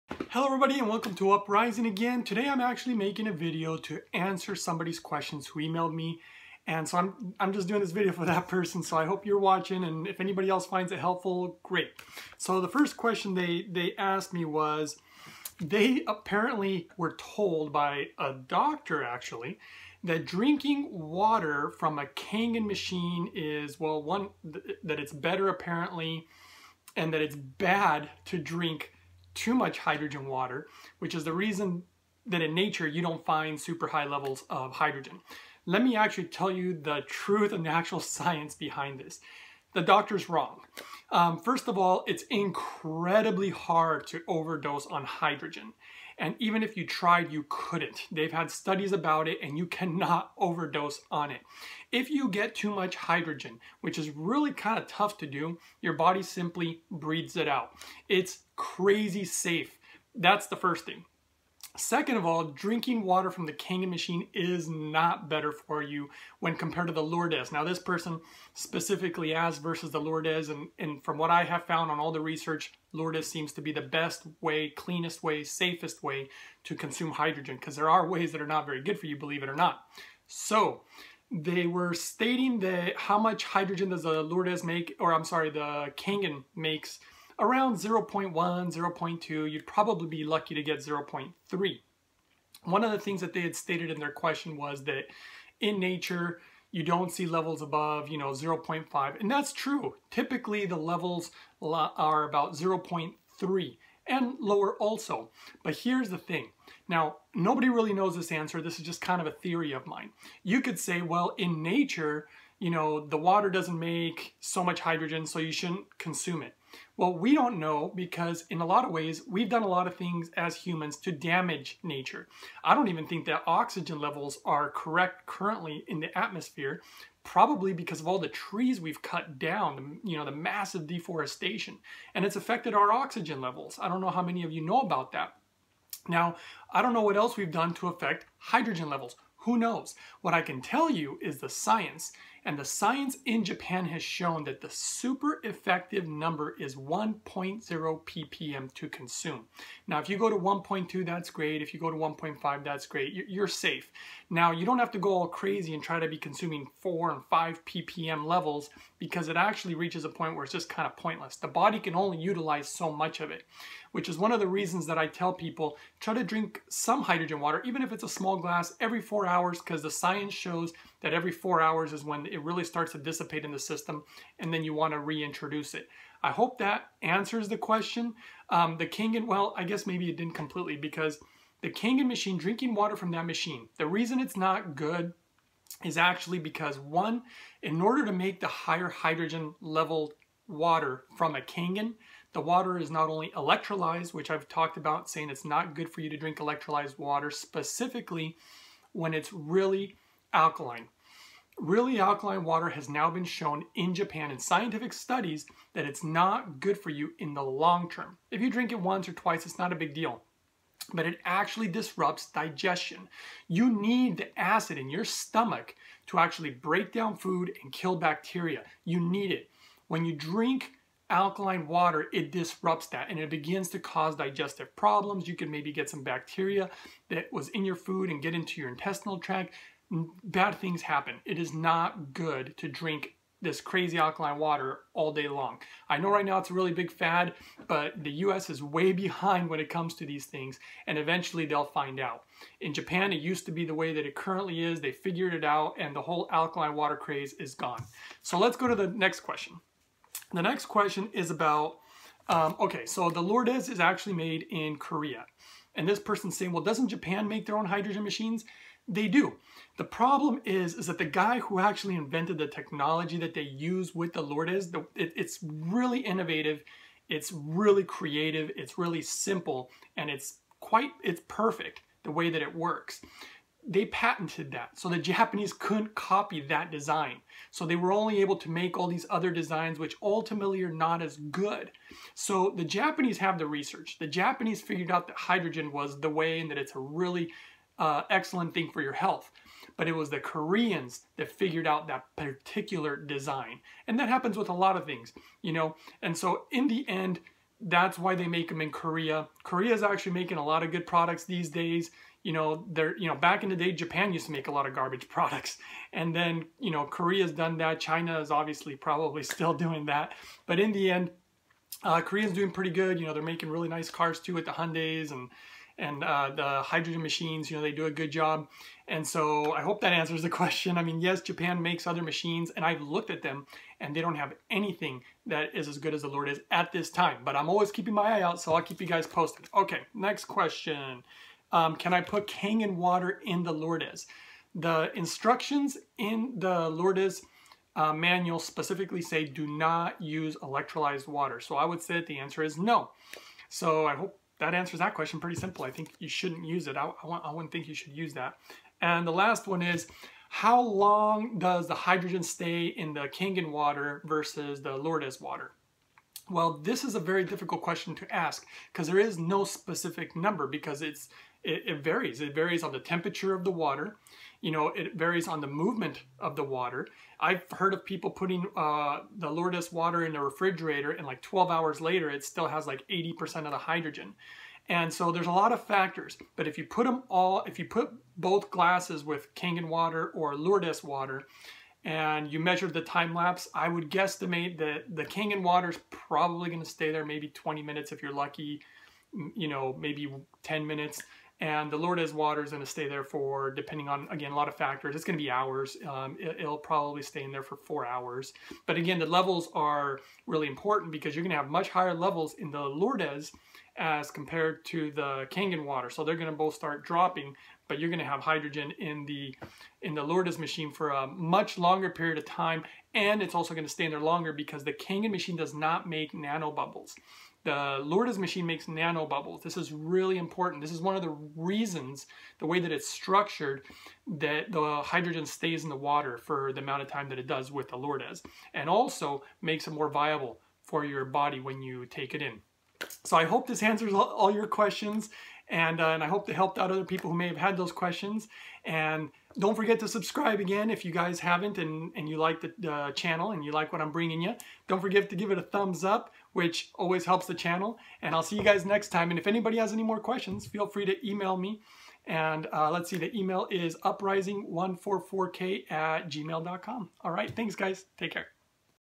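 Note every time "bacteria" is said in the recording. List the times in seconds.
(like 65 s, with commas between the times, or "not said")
217 s, 226 s.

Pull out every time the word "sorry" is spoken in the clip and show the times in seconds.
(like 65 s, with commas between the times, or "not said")
85 s.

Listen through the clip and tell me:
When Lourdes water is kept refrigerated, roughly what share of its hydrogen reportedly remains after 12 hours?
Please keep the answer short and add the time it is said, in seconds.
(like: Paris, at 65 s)
80%, at 372 s.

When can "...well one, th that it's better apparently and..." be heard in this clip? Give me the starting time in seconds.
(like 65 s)
23 s.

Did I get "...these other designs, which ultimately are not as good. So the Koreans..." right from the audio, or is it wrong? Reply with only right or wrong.
wrong.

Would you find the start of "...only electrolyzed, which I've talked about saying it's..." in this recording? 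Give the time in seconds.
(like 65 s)
193 s.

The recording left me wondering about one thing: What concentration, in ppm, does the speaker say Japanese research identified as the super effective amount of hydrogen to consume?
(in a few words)
1.0 ppm.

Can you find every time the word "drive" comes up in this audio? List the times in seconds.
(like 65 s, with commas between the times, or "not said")
not said.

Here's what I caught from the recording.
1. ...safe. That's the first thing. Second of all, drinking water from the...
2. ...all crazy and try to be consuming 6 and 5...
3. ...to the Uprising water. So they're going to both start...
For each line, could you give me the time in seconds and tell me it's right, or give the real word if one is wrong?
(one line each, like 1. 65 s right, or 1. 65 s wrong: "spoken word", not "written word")
1. 59 s right
2. 155 s wrong: "4", not "6"
3. 404 s wrong: "Kangen", not "Uprising".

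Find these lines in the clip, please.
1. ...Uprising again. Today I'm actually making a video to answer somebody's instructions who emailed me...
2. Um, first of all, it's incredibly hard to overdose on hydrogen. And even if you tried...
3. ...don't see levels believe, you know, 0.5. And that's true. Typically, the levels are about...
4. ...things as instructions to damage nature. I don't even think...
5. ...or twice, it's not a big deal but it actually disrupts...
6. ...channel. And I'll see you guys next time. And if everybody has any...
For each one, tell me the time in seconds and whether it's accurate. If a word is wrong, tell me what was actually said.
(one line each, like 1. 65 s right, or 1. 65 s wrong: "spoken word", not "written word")
1. 1 s wrong: "questions", not "instructions"
2. 41 s right
3. 96 s wrong: "above", not "believe"
4. 119 s wrong: "humans", not "instructions"
5. 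209 s right
6. 447 s wrong: "anybody", not "everybody".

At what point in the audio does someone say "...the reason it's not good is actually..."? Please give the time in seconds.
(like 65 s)
183 s.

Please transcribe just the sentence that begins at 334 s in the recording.
The instructions in the Lourdes uh, manual specifically say do not use electrolyzed water.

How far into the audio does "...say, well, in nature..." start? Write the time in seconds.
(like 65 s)
110 s.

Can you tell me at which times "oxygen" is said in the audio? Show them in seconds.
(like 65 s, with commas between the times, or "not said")
123 s, 132 s.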